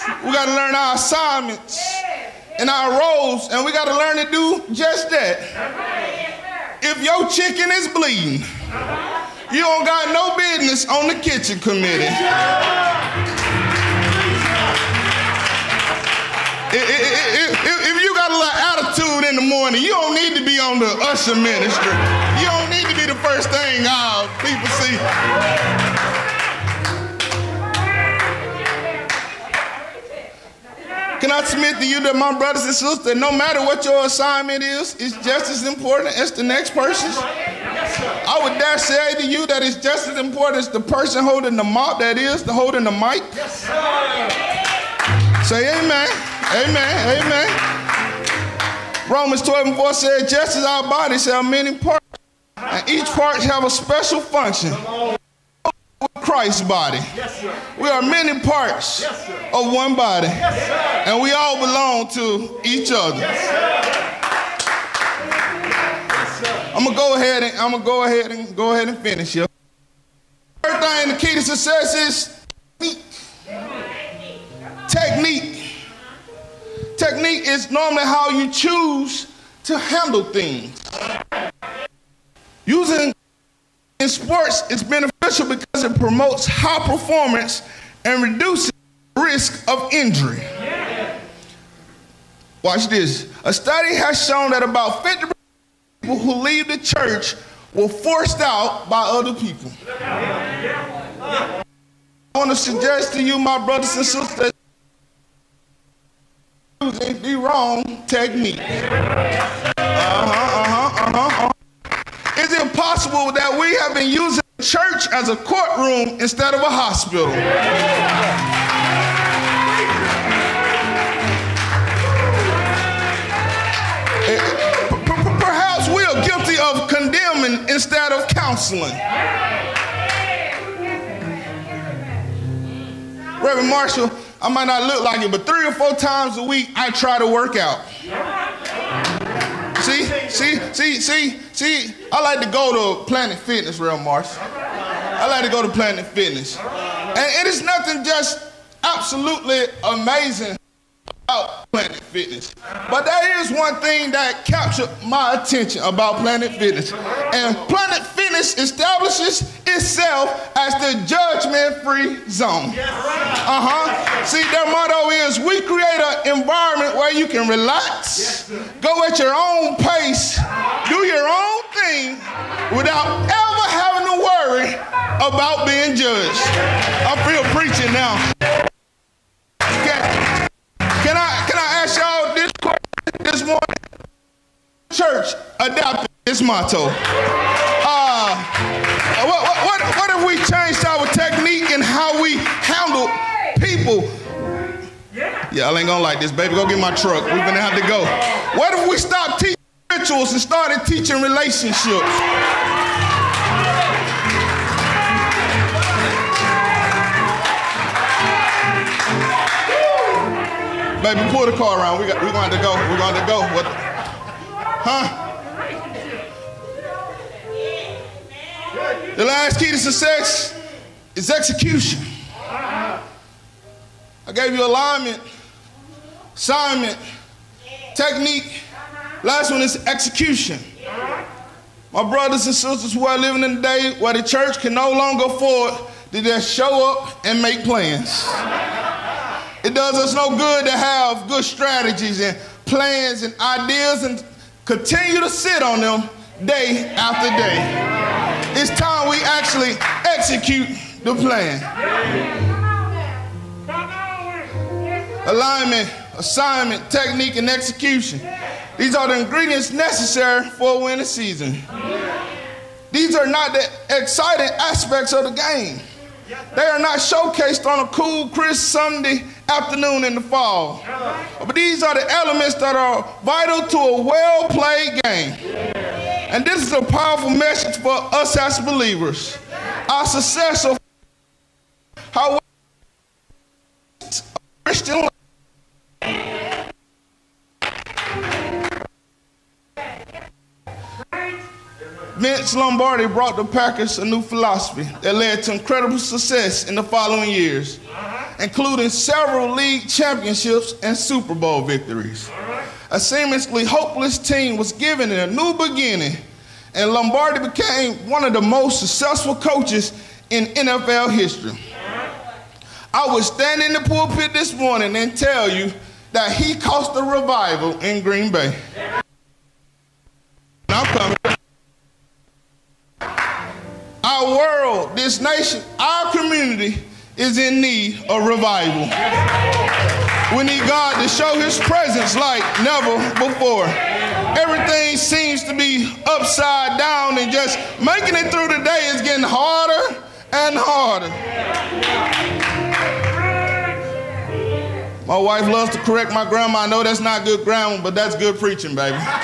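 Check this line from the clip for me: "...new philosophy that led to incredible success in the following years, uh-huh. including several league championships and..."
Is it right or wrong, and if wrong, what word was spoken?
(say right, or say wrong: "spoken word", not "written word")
right.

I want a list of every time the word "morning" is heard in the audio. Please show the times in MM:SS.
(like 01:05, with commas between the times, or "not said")
00:19, 03:03, 05:14.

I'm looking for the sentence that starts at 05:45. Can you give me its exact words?
My wife loves to correct my grandma.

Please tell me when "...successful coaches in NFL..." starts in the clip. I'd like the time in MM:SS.
05:08.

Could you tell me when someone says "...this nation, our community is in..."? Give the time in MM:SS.
05:24.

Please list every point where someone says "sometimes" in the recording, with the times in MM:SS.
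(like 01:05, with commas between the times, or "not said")
not said.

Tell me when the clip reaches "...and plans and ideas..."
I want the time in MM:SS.
04:02.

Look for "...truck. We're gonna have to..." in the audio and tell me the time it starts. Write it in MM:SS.
03:16.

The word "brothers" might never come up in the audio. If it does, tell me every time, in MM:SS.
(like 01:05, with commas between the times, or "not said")
00:32, 01:43, 03:52.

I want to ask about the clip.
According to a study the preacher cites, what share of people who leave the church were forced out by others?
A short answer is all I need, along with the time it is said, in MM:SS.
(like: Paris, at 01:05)
50%, at 01:35.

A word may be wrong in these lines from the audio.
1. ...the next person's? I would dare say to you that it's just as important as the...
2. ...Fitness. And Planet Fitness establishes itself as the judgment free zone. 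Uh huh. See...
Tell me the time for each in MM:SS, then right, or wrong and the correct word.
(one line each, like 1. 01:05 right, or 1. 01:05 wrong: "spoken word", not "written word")
1. 00:36 right
2. 02:36 right.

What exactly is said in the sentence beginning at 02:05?
Perhaps we are guilty of condemning instead of counseling.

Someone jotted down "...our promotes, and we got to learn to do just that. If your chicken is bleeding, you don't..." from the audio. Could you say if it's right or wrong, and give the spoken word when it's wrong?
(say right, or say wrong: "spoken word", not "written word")
wrong: "roles", not "promotes".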